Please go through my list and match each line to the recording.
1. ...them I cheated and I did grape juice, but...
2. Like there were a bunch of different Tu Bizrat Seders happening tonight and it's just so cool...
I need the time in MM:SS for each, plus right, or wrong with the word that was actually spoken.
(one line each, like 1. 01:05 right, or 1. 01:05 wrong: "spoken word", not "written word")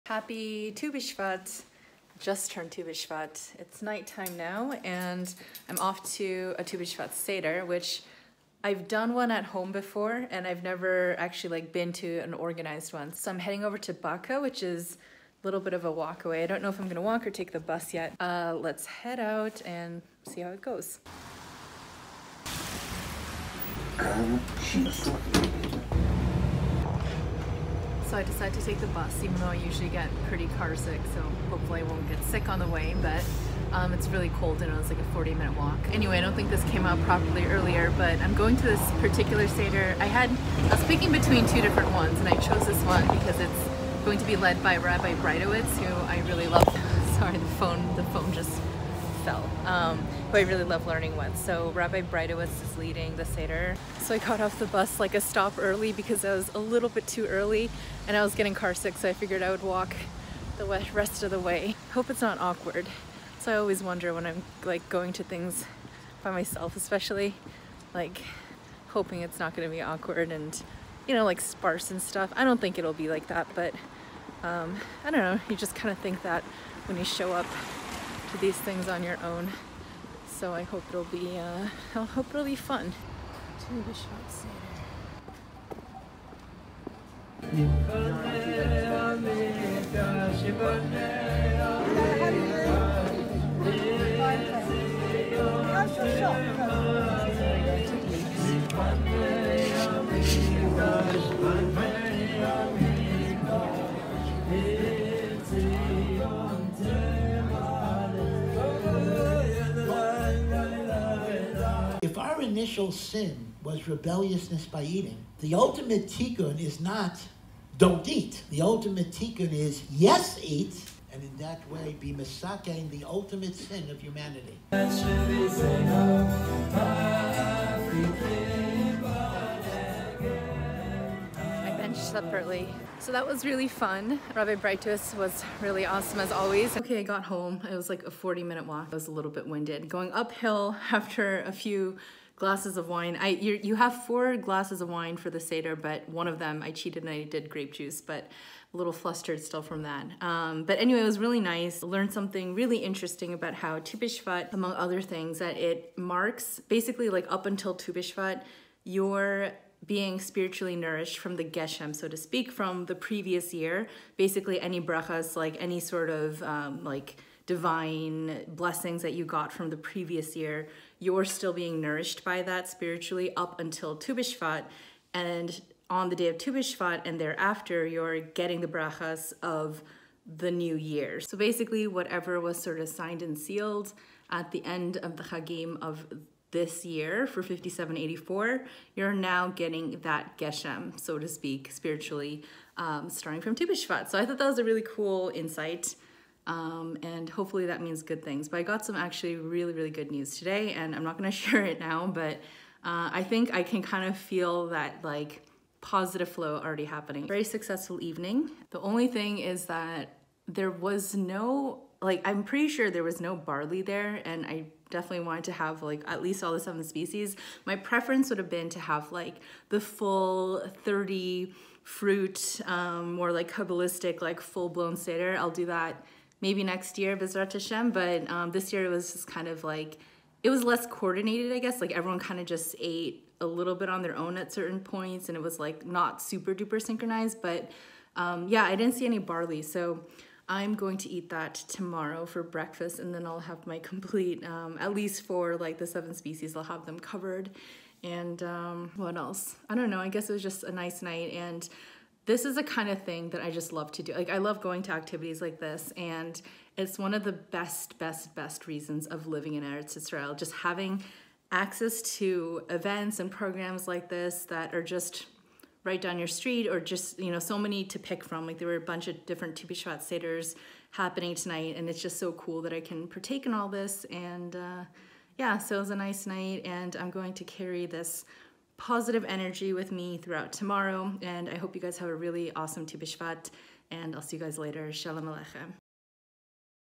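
1. 02:26 right
2. 04:28 wrong: "BiShvat", not "Bizrat".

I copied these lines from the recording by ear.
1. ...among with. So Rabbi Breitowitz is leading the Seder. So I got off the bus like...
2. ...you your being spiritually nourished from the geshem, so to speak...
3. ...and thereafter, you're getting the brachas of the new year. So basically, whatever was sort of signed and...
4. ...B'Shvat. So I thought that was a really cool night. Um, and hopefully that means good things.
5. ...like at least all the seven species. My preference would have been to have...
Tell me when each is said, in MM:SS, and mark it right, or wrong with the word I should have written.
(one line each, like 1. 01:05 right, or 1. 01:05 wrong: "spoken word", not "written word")
1. 00:50 wrong: "learning", not "among"
2. 02:37 right
3. 02:57 right
4. 03:13 wrong: "insight", not "night"
5. 03:35 right.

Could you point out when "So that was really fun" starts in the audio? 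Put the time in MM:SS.
02:12.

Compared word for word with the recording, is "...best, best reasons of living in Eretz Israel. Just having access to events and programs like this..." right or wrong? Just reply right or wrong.
right.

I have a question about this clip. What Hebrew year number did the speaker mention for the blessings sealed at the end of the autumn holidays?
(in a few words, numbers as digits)
5784.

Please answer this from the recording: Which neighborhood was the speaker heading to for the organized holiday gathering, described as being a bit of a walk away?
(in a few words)
Baka.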